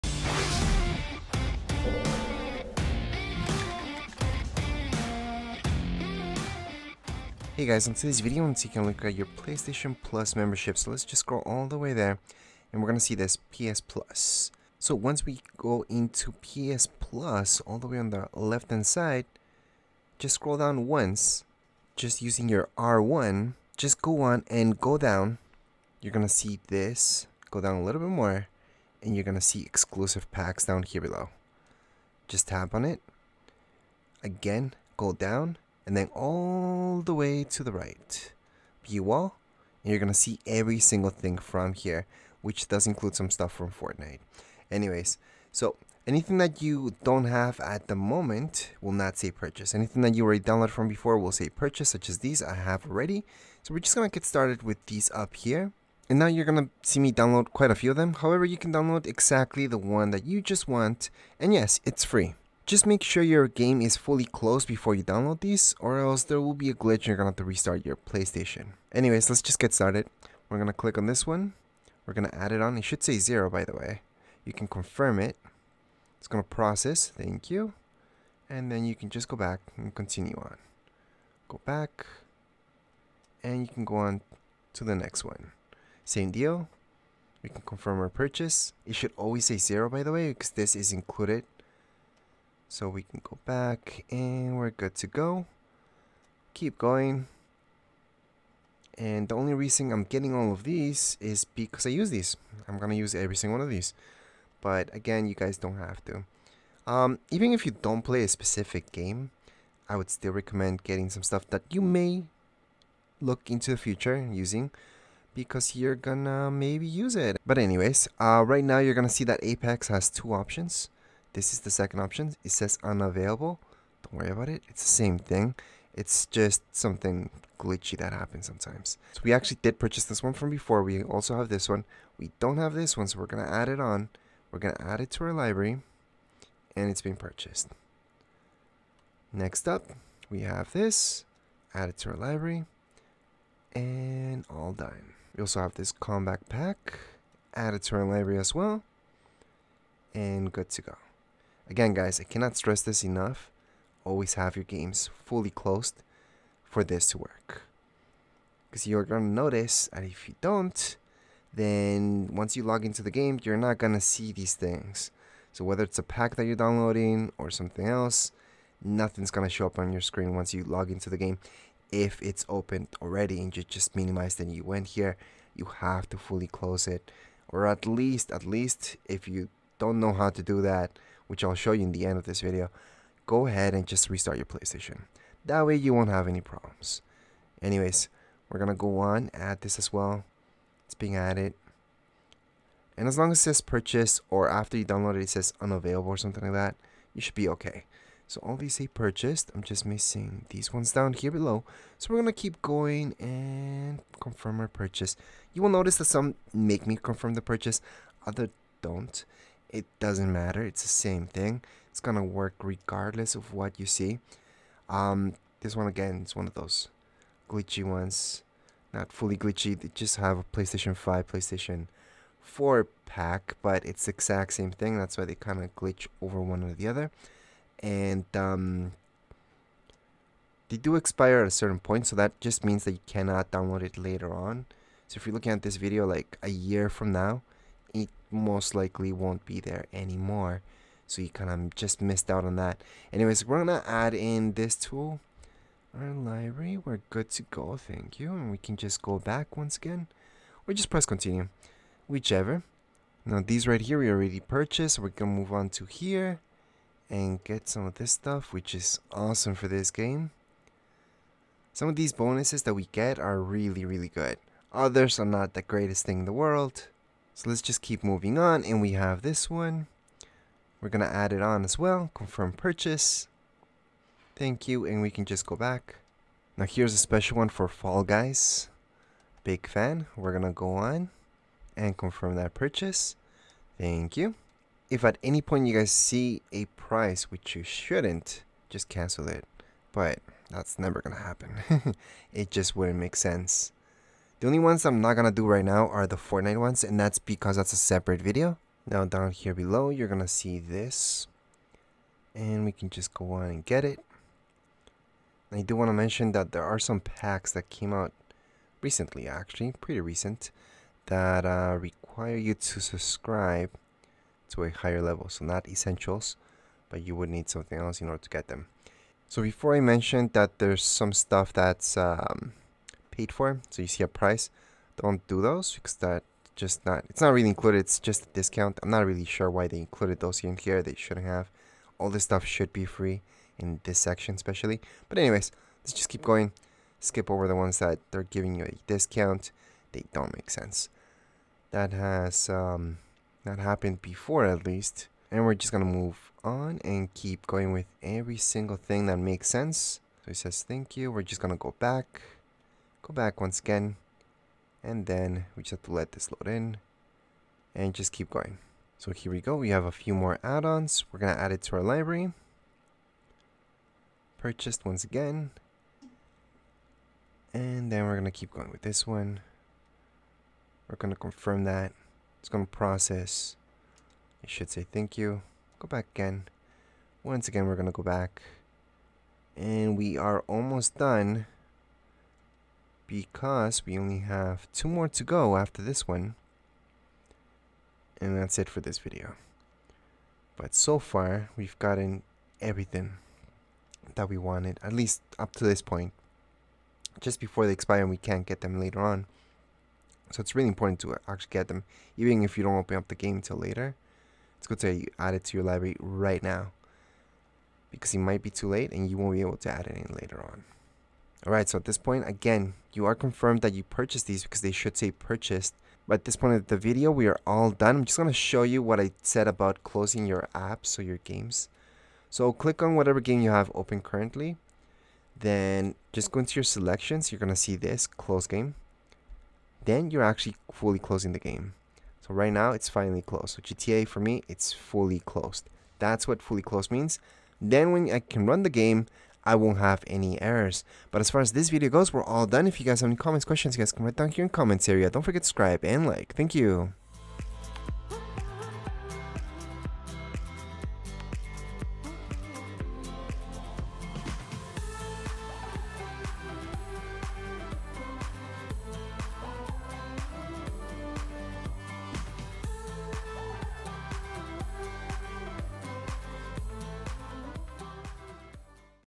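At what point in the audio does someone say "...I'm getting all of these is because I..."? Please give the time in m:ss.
1:39.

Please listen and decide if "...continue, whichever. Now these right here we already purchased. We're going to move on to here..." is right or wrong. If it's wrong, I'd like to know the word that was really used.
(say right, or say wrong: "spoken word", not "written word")
right.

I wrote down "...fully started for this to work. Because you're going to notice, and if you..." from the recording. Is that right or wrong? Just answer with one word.
wrong.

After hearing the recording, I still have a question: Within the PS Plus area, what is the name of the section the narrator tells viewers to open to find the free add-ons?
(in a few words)
Exclusive packs.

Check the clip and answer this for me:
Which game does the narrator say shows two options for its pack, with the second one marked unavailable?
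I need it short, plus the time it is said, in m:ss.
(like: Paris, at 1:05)
Apex, at 1:59.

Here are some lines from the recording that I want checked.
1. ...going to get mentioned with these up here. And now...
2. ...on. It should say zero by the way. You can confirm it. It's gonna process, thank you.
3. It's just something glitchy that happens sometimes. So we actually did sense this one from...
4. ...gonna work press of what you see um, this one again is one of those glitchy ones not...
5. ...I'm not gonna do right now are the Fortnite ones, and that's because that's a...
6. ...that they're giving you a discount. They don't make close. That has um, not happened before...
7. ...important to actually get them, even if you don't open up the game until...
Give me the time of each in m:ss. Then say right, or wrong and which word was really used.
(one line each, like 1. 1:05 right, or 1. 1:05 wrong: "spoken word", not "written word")
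1. 0:53 wrong: "started", not "mentioned"
2. 1:12 right
3. 2:05 wrong: "purchase", not "sense"
4. 3:31 wrong: "regardless", not "press"
5. 4:54 right
6. 5:37 wrong: "sense", not "close"
7. 6:40 right.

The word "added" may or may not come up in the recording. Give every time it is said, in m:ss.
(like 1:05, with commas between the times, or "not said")
3:11.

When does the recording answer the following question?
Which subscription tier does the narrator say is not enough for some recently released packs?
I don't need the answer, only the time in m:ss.
5:15.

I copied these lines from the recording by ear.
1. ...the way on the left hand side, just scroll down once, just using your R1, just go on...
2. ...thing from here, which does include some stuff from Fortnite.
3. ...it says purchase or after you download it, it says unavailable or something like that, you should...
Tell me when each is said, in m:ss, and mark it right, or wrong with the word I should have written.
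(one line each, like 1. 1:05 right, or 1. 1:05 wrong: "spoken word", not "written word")
1. 0:17 right
2. 0:41 right
3. 3:13 right.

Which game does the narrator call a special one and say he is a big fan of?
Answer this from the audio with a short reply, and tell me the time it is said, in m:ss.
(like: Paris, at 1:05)
Fall Guys, at 4:37.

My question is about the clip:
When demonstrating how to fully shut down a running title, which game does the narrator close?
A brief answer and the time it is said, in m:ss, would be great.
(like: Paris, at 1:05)
GTA, at 7:13.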